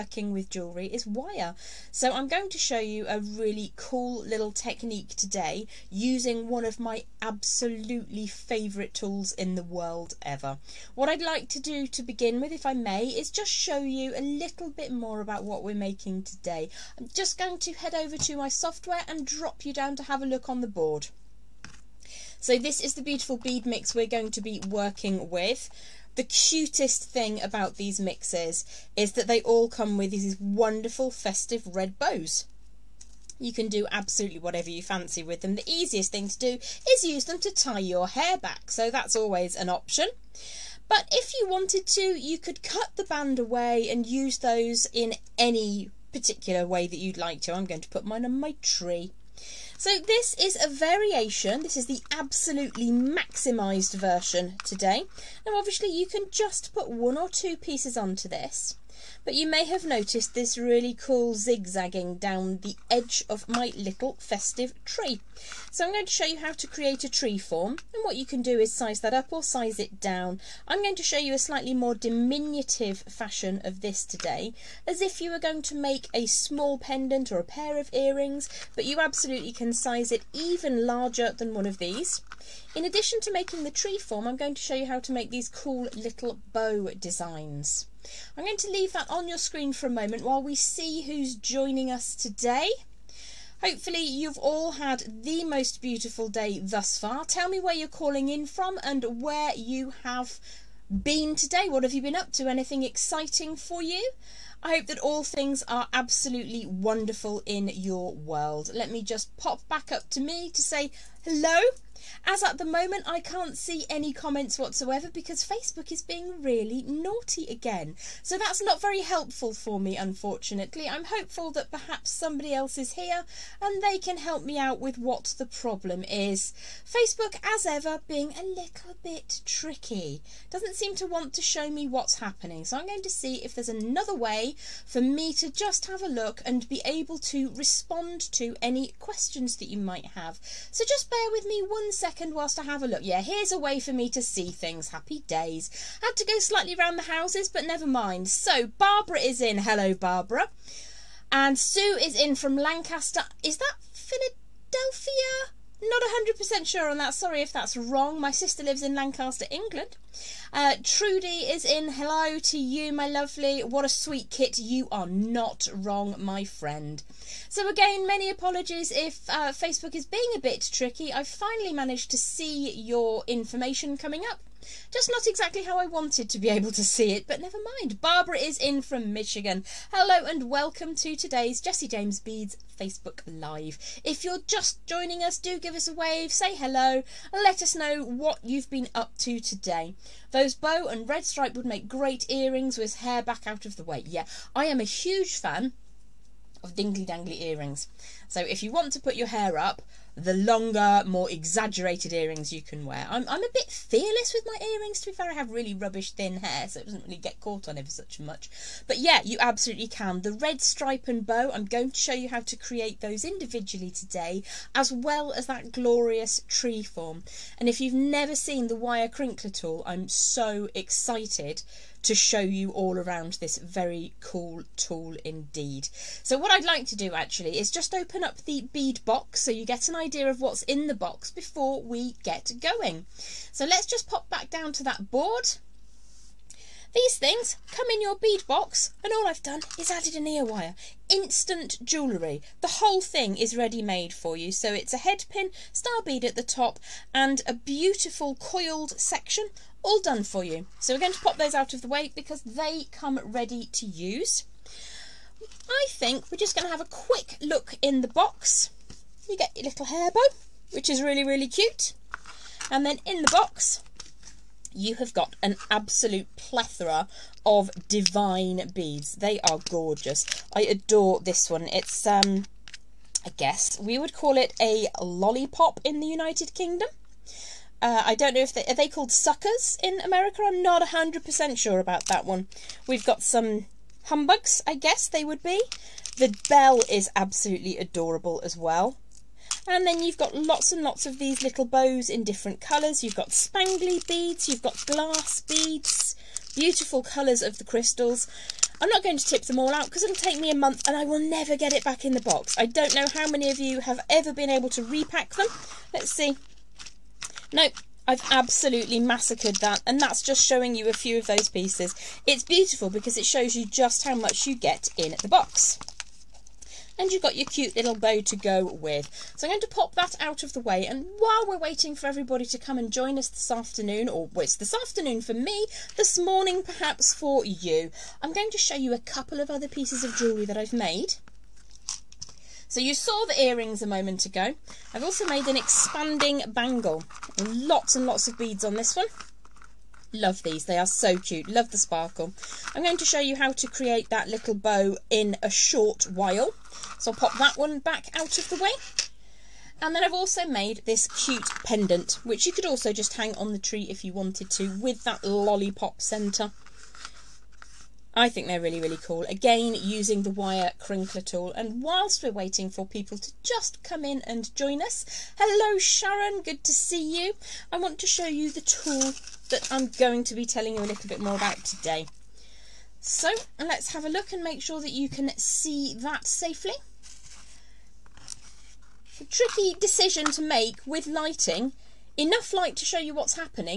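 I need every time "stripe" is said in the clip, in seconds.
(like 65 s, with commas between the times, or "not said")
191 s, 210 s.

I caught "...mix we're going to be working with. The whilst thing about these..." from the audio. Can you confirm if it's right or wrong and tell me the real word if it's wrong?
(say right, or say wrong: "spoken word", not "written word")
wrong: "cutest", not "whilst".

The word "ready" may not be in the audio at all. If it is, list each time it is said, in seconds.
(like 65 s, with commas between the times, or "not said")
243 s, 253 s.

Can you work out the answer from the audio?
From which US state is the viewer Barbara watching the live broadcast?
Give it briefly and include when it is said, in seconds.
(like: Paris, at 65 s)
Michigan, at 179 s.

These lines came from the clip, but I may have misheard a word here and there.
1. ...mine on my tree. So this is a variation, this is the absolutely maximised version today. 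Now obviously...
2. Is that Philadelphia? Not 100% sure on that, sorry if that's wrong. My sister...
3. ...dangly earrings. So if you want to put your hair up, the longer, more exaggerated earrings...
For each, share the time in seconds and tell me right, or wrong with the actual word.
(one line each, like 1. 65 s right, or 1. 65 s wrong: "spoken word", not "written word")
1. 48 s right
2. 153 s right
3. 197 s right.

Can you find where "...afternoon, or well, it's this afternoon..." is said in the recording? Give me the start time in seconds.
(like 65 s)
323 s.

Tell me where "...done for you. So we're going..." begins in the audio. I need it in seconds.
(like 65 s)
249 s.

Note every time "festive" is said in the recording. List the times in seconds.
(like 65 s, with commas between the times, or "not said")
31 s, 64 s.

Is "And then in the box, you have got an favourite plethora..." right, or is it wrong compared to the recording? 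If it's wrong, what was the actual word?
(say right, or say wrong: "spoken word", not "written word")
wrong: "absolute", not "favourite".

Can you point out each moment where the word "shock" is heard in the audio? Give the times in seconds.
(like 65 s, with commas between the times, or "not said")
not said.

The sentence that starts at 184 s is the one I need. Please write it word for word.
If you're just joining us, do give us a wave, say hello, let us know what you've been up to today.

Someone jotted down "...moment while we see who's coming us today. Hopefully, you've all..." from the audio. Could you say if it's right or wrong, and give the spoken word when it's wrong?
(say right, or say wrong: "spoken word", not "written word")
wrong: "joining", not "coming".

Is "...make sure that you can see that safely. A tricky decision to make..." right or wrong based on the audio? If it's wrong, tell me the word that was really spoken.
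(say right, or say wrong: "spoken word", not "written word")
right.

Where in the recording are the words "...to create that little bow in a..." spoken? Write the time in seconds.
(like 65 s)
343 s.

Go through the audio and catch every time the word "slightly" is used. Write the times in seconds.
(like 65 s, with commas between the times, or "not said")
71 s, 146 s.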